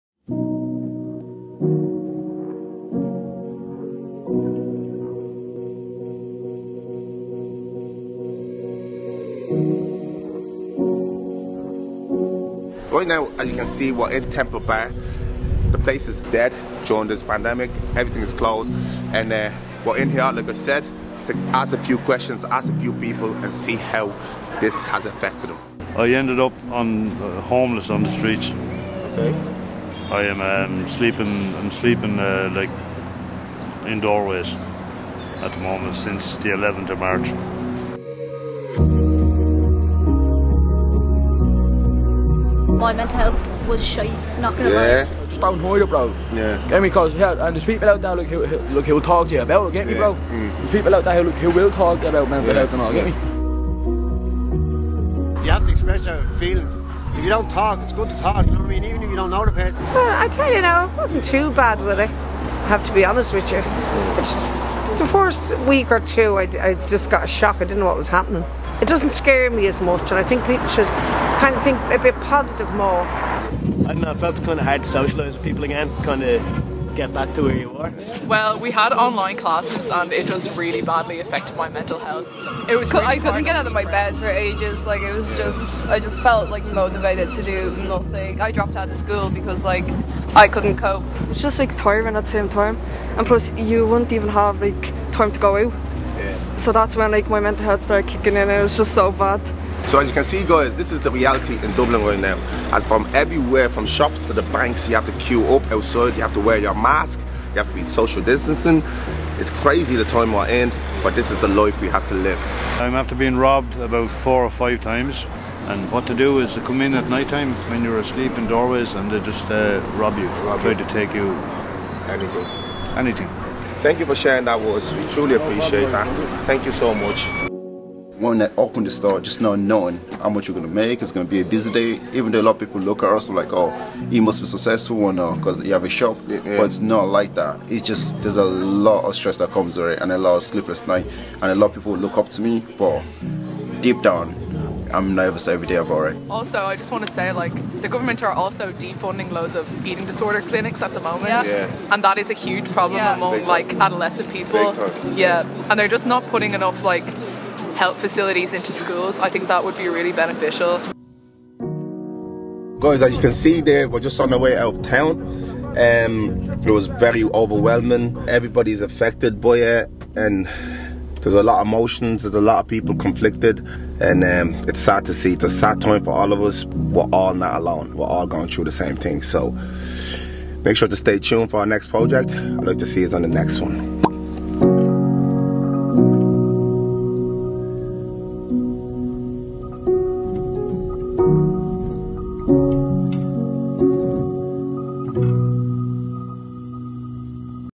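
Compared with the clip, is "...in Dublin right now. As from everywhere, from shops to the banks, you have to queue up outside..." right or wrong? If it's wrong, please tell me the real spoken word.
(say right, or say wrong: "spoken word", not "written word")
right.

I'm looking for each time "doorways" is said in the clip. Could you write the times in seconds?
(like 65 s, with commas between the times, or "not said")
34 s, 118 s.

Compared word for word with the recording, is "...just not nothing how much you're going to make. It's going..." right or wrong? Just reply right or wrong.
wrong.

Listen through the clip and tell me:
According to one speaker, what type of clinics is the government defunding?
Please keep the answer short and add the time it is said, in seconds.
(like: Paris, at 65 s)
Eating disorder clinics, at 149 s.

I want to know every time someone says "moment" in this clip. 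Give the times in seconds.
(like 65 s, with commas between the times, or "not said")
35 s, 150 s.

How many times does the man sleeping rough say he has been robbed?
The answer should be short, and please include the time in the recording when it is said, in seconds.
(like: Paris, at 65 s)
4 or 5, at 114 s.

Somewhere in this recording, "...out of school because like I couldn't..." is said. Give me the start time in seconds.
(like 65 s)
88 s.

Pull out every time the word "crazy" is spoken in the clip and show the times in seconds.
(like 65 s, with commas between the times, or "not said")
109 s.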